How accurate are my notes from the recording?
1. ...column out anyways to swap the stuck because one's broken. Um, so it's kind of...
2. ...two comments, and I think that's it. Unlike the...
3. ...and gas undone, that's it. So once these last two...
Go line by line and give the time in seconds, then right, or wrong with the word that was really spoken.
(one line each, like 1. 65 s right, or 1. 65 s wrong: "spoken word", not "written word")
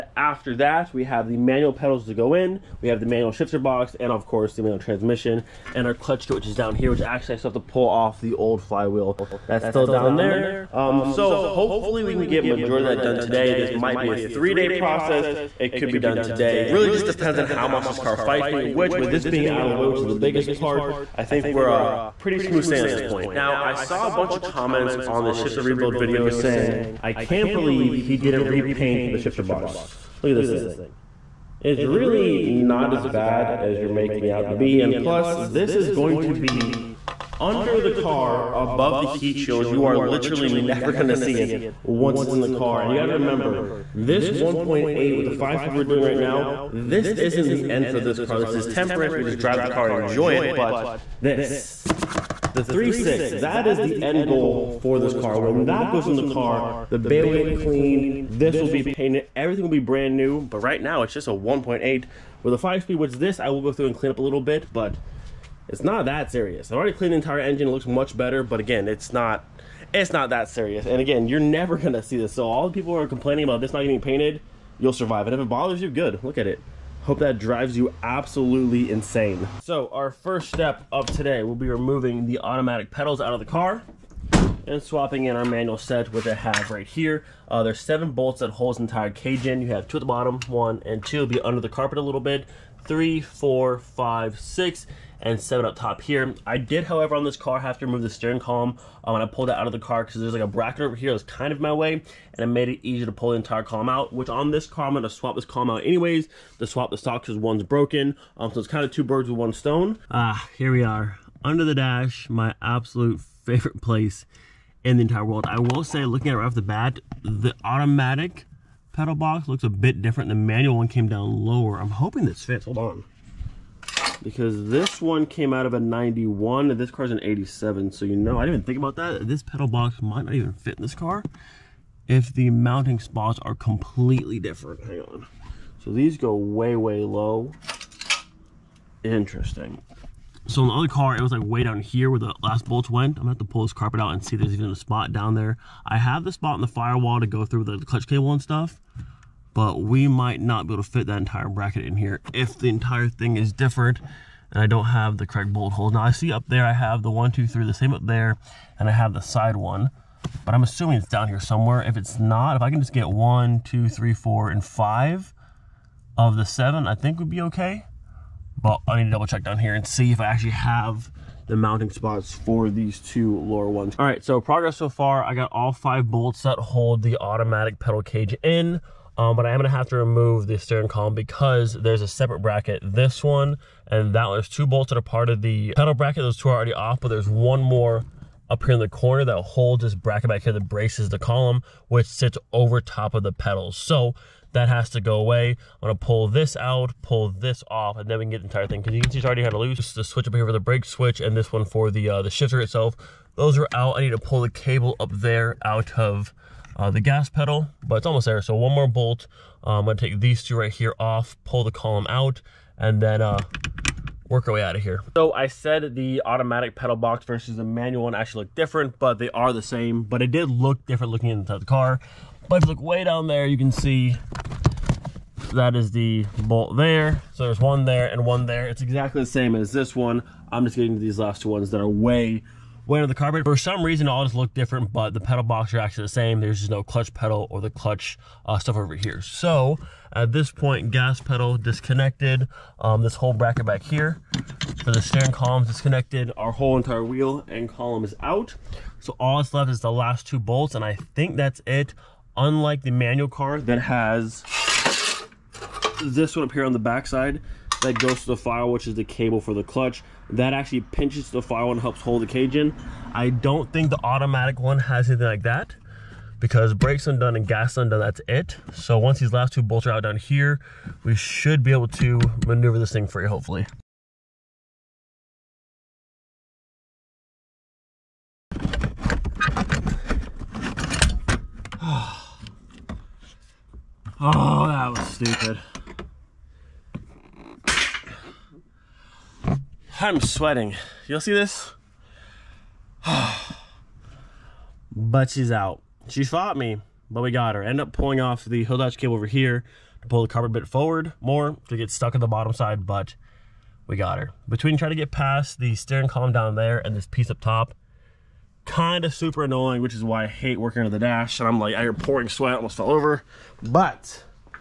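1. 105 s wrong: "stock", not "stuck"
2. 250 s wrong: "bolts", not "comments"
3. 267 s right.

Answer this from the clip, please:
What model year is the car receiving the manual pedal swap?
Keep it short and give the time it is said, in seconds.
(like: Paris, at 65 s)
1987, at 127 s.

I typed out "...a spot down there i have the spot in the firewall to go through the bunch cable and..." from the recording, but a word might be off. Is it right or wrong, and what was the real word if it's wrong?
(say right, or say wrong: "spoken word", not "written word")
wrong: "clutch", not "bunch".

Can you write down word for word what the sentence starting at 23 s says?
Now, I saw a bunch of comments on the shifter rebuild video saying, I can't believe he didn't repaint the shifter box.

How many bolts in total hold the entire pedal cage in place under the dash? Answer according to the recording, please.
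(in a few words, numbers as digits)
7.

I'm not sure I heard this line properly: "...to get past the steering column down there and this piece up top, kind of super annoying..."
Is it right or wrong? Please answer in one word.
right.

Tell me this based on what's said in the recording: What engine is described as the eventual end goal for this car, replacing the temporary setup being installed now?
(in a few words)
3.6.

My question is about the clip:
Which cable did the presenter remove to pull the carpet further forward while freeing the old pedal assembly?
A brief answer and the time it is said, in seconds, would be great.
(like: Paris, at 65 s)
hood latch cable, at 298 s.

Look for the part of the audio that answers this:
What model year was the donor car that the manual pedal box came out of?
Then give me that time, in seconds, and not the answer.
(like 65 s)
125 s.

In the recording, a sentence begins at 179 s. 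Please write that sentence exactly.
Um, but I am gonna have to remove the steering column because there's a separate bracket.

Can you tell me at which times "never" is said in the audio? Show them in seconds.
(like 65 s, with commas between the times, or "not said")
40 s, 71 s.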